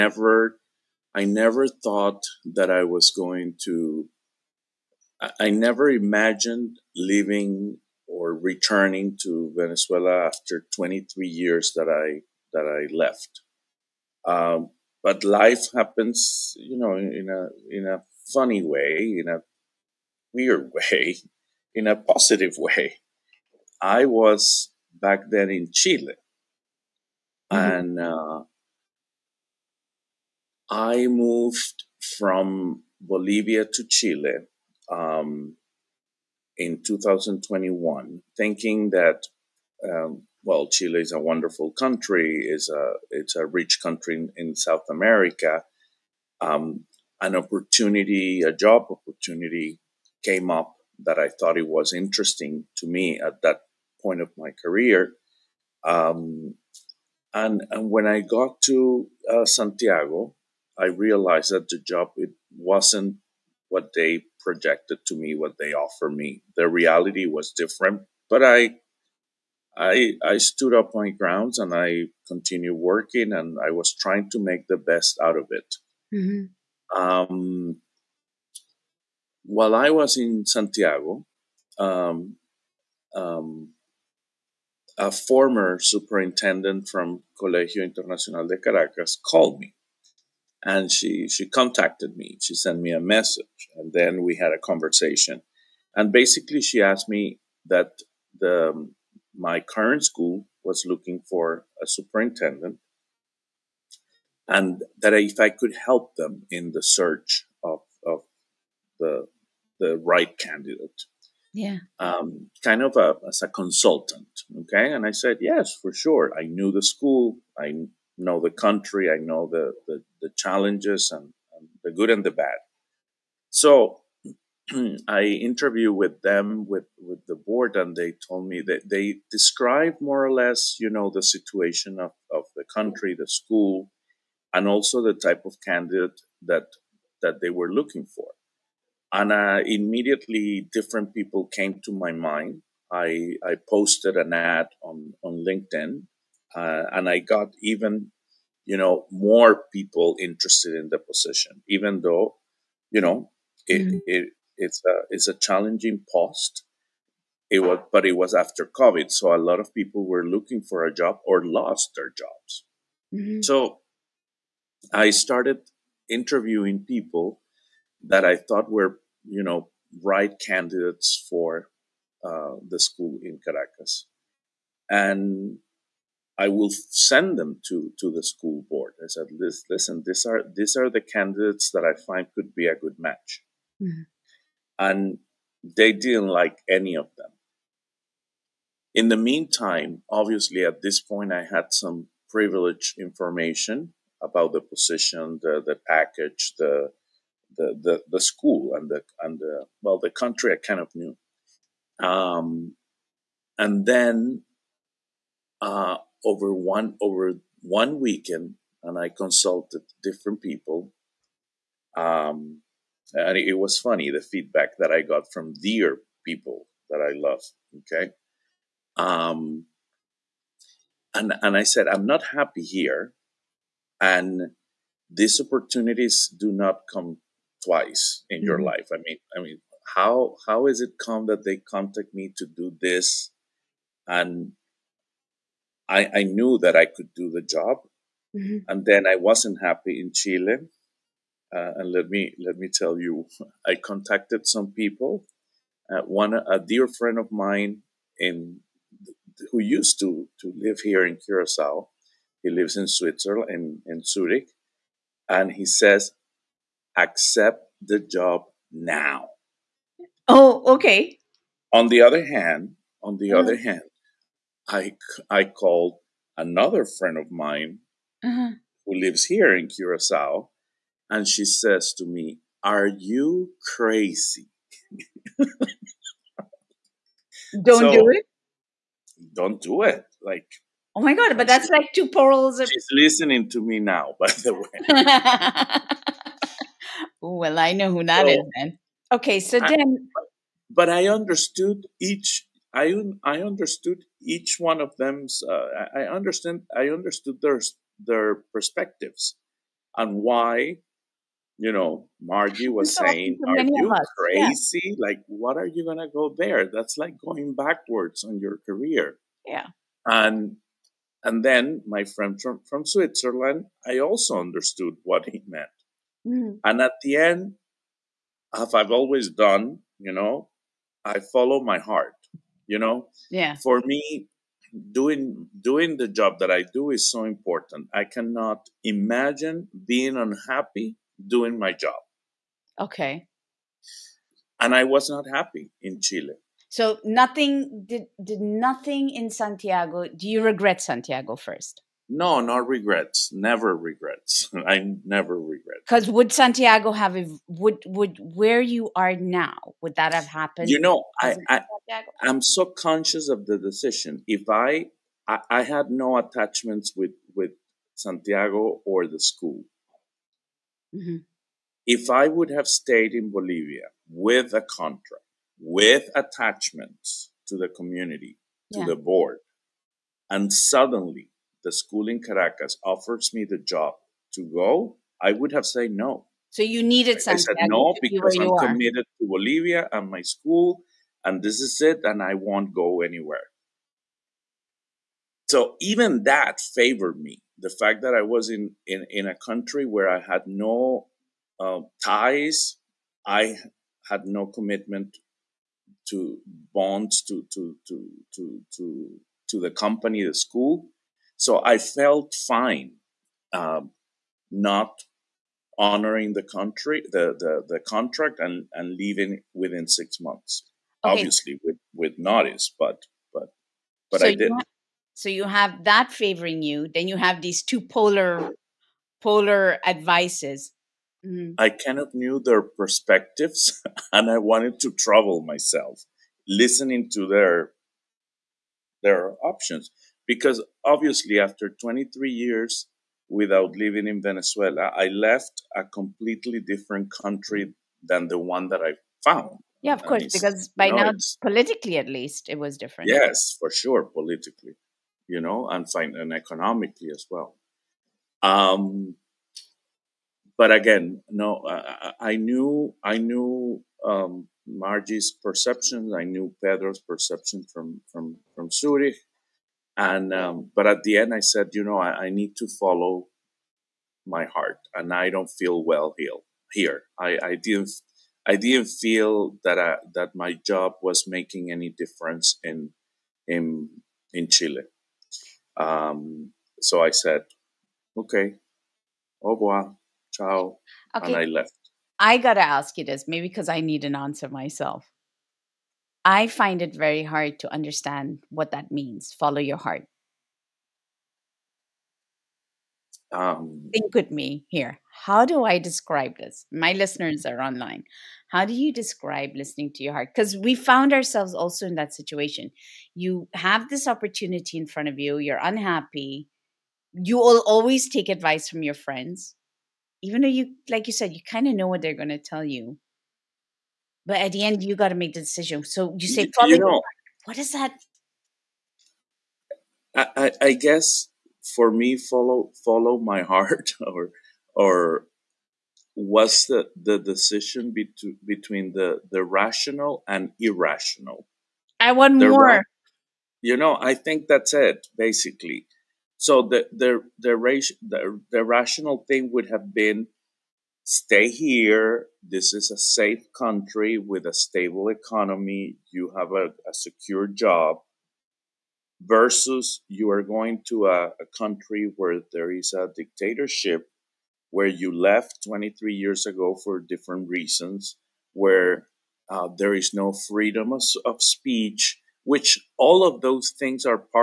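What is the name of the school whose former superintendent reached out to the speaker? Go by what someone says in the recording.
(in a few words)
Colegio Internacional de Caracas.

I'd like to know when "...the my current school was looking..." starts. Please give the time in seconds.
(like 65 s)
98 s.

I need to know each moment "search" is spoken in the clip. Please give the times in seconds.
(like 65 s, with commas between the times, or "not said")
106 s.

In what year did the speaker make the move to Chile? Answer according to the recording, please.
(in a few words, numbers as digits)
2021.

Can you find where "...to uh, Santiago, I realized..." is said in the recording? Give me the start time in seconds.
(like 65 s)
58 s.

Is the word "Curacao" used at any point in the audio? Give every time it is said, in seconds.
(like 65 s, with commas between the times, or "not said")
251 s, 269 s.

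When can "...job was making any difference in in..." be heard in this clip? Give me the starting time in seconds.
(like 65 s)
470 s.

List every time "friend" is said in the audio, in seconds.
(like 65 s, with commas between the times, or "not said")
246 s, 266 s, 312 s, 508 s.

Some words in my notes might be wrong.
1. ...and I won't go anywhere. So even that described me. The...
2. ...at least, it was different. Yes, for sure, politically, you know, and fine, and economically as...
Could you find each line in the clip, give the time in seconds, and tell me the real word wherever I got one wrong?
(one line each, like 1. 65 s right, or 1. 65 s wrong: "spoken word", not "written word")
1. 382 s wrong: "favored", not "described"
2. 441 s right.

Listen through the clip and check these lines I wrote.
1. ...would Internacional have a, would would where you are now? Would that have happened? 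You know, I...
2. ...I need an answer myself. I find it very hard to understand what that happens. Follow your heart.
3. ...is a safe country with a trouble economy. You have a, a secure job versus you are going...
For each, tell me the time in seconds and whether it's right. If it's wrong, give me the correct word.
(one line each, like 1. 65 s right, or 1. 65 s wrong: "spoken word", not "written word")
1. 346 s wrong: "Santiago", not "Internacional"
2. 483 s wrong: "means", not "happens"
3. 542 s wrong: "stable", not "trouble".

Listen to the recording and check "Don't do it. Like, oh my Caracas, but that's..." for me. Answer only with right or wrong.
wrong.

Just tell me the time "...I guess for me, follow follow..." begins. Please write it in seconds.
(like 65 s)
520 s.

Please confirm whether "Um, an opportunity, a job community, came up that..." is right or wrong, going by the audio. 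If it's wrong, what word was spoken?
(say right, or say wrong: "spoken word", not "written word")
wrong: "opportunity", not "community".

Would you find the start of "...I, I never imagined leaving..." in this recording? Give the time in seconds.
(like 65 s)
5 s.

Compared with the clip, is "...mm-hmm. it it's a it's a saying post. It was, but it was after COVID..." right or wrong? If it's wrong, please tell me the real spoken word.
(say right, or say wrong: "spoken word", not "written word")
wrong: "challenging", not "saying".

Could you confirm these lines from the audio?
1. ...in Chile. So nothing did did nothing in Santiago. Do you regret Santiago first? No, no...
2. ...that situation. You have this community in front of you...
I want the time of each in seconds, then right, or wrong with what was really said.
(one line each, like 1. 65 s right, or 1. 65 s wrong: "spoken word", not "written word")
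1. 335 s right
2. 501 s wrong: "opportunity", not "community".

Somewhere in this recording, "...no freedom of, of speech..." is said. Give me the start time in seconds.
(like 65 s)
560 s.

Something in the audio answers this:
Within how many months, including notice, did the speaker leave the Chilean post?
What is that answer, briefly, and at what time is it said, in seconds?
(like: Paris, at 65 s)
6, at 409 s.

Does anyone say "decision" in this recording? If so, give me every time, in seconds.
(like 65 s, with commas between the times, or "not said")
353 s, 515 s, 527 s.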